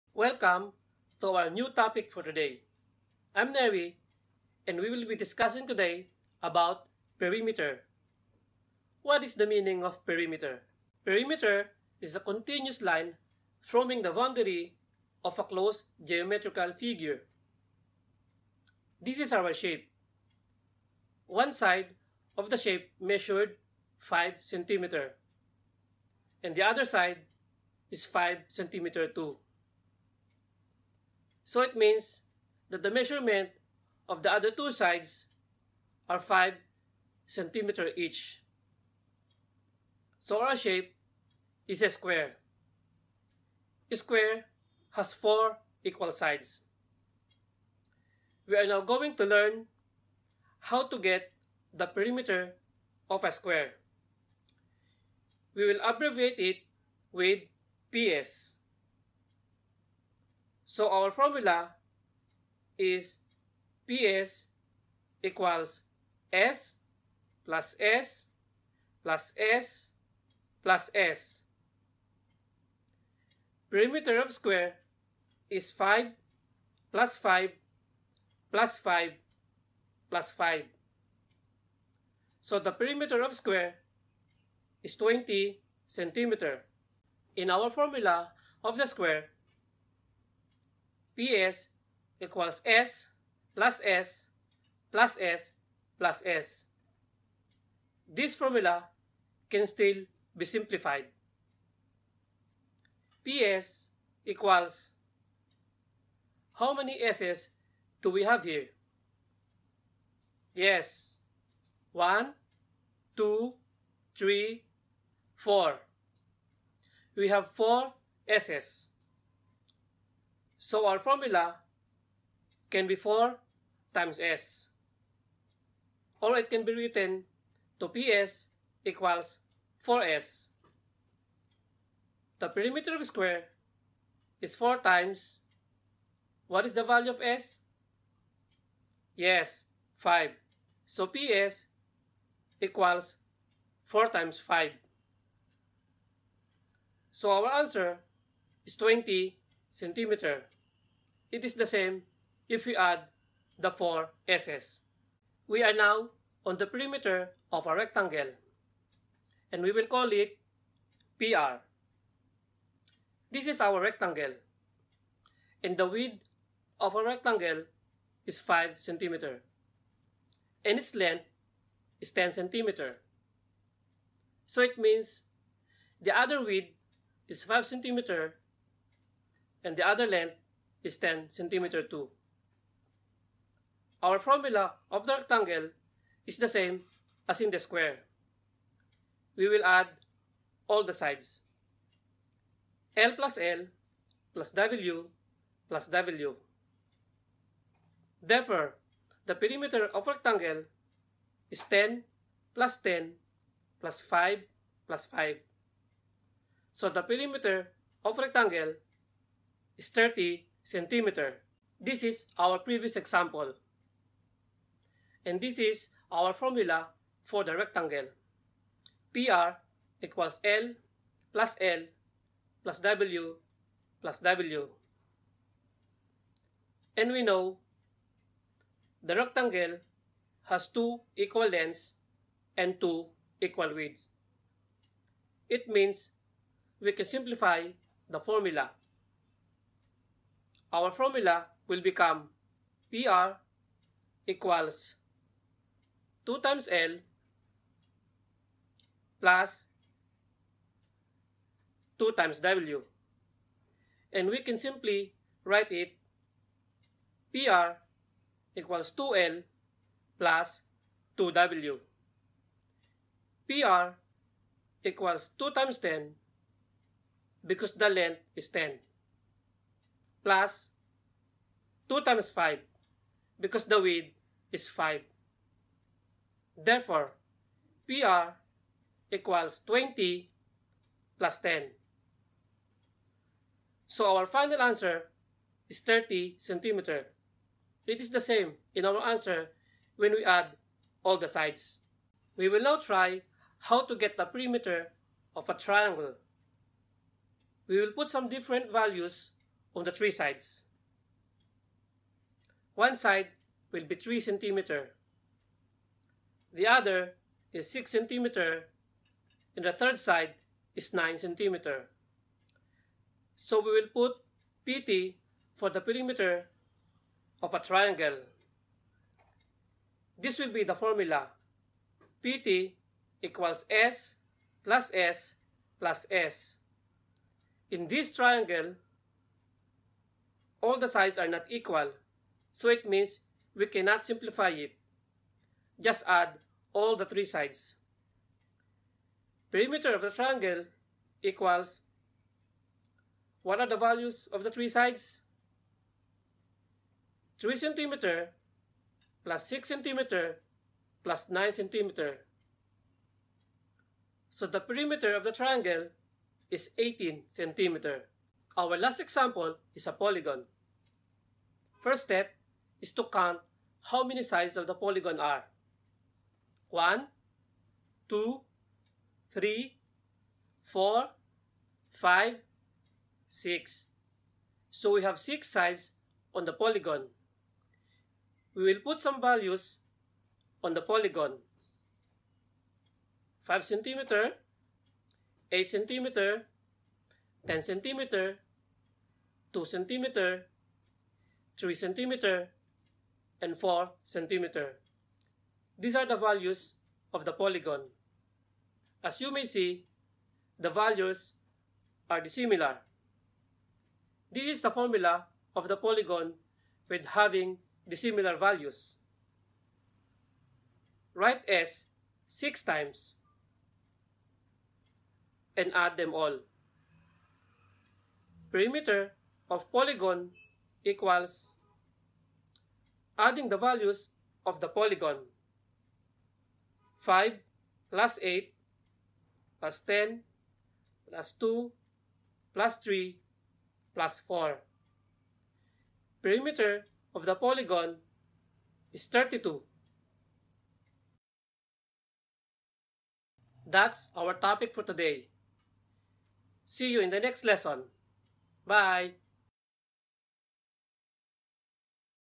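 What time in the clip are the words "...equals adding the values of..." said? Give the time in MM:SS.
07:00.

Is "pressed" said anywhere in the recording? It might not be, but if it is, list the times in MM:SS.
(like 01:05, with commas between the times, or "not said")
not said.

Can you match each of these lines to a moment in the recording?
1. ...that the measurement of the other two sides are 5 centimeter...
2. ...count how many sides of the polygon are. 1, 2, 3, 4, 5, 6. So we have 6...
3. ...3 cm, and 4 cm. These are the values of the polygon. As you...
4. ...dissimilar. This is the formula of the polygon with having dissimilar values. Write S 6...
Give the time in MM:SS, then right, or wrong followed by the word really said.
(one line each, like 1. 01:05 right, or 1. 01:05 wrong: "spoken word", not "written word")
1. 00:32 right
2. 06:03 right
3. 06:31 right
4. 06:42 right.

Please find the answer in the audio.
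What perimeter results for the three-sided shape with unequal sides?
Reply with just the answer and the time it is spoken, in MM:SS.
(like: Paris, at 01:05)
18 cm, at 05:56.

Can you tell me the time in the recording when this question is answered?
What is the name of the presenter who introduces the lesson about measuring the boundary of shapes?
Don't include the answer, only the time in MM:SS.
00:03.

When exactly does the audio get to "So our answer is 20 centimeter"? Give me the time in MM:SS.
02:27.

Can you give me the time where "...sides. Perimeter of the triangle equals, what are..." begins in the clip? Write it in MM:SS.
05:37.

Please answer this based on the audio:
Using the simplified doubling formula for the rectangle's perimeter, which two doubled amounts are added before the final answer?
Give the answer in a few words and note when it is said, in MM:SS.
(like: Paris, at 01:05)
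20 plus 10, at 04:39.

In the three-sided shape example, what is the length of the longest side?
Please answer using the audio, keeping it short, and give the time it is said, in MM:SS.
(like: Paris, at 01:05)
9 cm, at 05:10.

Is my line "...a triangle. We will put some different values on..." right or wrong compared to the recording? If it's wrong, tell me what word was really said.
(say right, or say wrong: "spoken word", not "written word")
right.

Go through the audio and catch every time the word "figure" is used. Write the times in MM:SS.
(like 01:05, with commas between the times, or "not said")
00:16.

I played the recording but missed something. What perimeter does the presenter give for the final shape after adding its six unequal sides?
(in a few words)
32.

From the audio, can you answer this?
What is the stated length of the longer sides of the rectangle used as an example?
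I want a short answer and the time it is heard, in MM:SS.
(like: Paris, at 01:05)
10 cm, at 02:52.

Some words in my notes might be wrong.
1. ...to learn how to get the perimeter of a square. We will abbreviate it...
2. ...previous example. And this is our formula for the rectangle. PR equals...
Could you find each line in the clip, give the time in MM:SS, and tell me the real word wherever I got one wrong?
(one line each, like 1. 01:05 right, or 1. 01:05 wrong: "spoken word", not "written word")
1. 00:49 right
2. 03:32 right.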